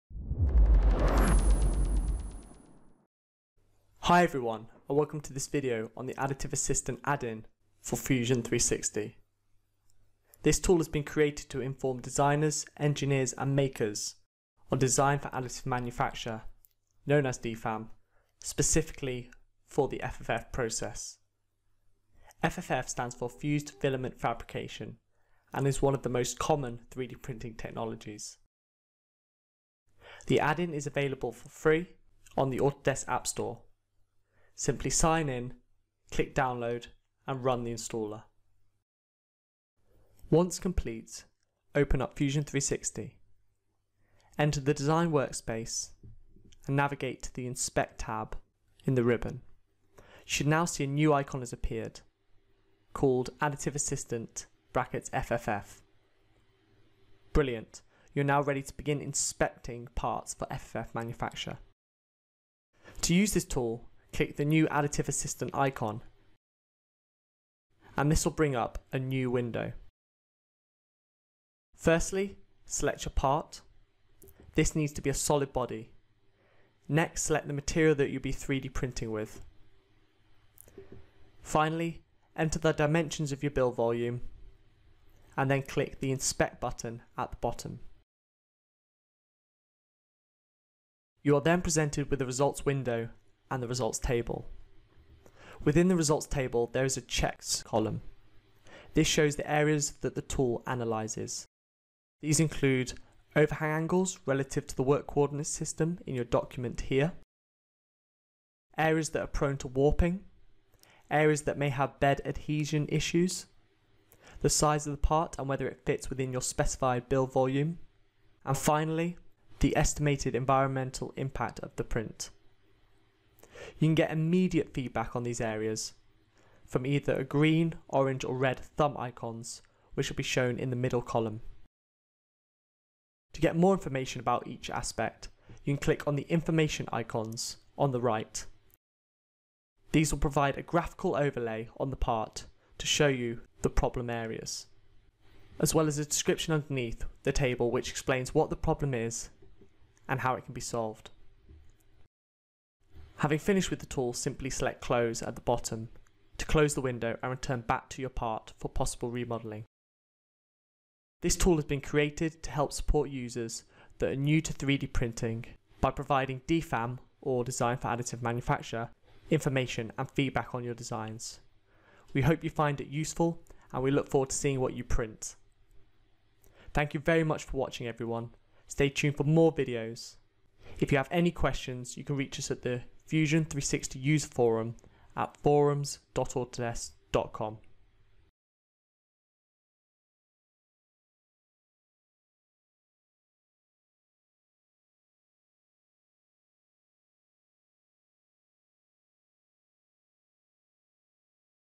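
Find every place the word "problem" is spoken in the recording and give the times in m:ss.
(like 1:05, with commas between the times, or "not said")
2:23, 2:28.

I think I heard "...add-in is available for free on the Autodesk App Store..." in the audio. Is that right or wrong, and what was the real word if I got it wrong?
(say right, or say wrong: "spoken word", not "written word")
right.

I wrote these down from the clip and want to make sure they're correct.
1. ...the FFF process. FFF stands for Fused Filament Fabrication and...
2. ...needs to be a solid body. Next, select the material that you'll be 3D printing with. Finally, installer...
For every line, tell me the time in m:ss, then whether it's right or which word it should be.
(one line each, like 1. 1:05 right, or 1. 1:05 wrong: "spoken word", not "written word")
1. 0:19 right
2. 1:14 wrong: "enter", not "installer".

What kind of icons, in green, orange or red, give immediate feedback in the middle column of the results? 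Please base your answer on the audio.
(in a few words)
Thumb icons.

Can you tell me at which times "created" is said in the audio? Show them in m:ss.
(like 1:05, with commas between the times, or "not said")
0:11, 2:41.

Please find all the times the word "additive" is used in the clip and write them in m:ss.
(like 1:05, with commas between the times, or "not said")
0:06, 0:15, 0:53, 1:04, 2:47.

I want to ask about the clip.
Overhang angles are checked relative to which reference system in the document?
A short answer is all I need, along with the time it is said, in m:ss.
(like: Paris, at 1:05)
Work coordinate system, at 1:44.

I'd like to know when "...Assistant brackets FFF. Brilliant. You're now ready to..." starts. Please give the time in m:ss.
0:53.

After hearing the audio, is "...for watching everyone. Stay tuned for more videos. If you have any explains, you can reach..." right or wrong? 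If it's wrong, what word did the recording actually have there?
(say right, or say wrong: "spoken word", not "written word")
wrong: "questions", not "explains".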